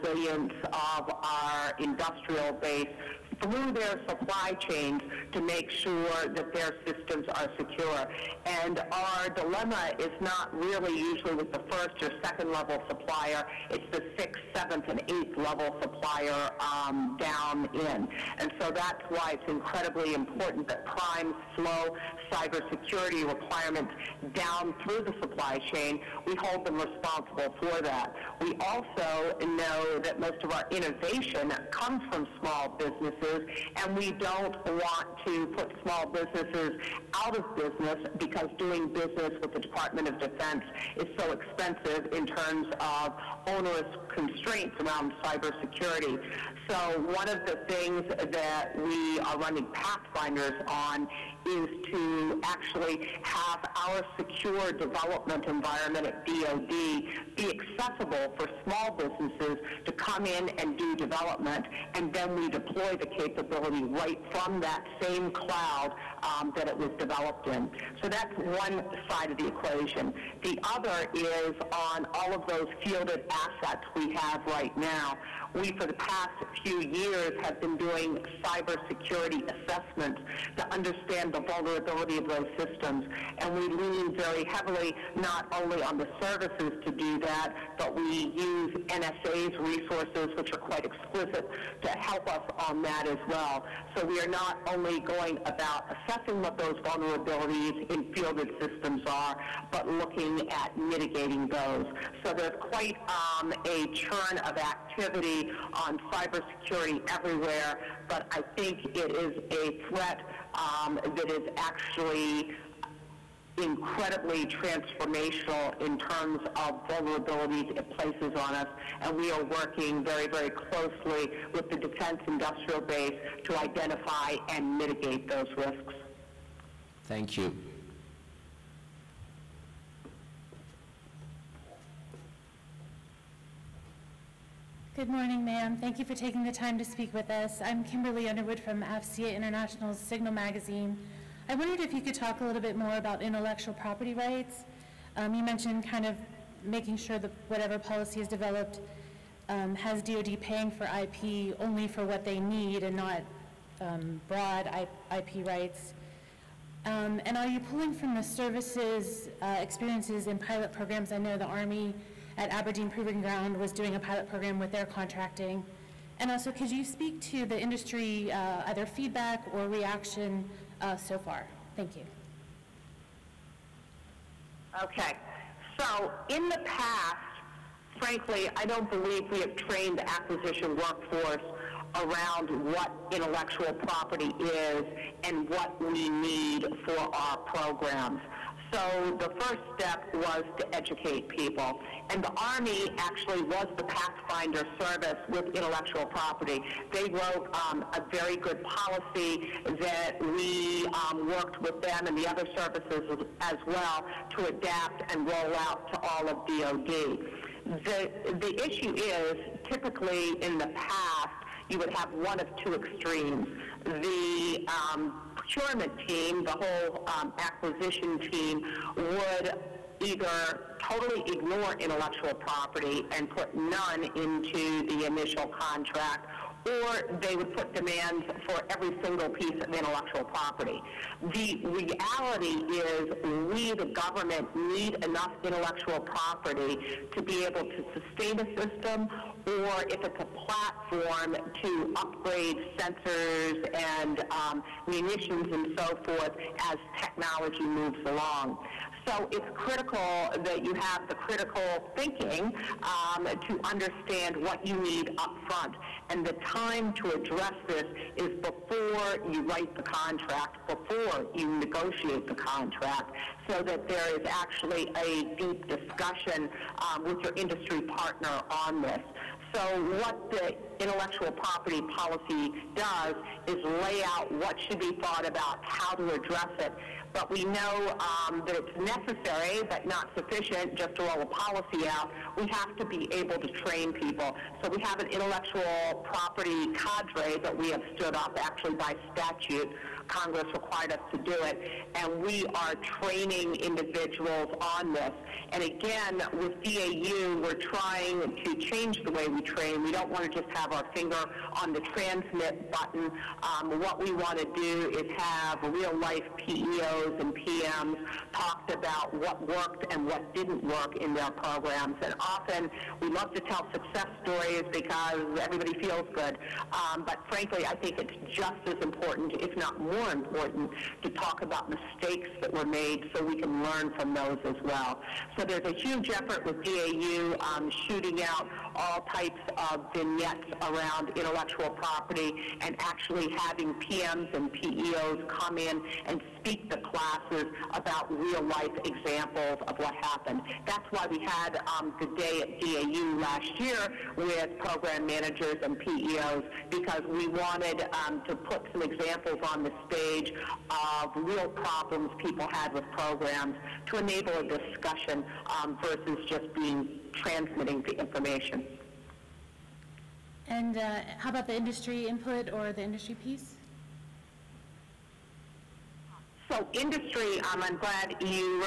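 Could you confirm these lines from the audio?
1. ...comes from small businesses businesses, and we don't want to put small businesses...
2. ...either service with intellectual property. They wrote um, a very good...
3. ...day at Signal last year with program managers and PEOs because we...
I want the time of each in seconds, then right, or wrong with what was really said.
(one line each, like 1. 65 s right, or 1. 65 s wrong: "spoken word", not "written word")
1. 31 s right
2. 193 s wrong: "pathfinder", not "either"
3. 342 s wrong: "DAU", not "Signal".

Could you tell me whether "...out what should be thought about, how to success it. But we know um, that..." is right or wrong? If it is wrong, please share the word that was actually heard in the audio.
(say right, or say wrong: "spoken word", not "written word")
wrong: "address", not "success".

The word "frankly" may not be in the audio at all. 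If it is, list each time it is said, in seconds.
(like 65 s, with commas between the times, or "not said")
177 s, 317 s.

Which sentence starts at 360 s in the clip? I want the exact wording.
And uh, how about the industry input or the industry piece?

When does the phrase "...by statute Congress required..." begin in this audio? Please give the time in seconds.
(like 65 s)
288 s.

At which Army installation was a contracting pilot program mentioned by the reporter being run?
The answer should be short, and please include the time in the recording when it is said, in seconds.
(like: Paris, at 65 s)
Aberdeen Proving Ground, at 162 s.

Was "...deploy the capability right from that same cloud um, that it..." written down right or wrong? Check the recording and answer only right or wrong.
right.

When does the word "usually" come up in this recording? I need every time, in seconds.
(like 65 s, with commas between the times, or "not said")
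10 s.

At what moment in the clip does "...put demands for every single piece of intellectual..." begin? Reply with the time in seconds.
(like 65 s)
227 s.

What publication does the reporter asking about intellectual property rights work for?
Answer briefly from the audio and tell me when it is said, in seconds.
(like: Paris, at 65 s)
Signal Magazine, at 139 s.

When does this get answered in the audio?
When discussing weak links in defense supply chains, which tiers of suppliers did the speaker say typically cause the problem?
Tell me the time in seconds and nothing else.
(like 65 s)
14 s.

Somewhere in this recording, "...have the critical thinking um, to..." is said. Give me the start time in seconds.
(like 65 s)
250 s.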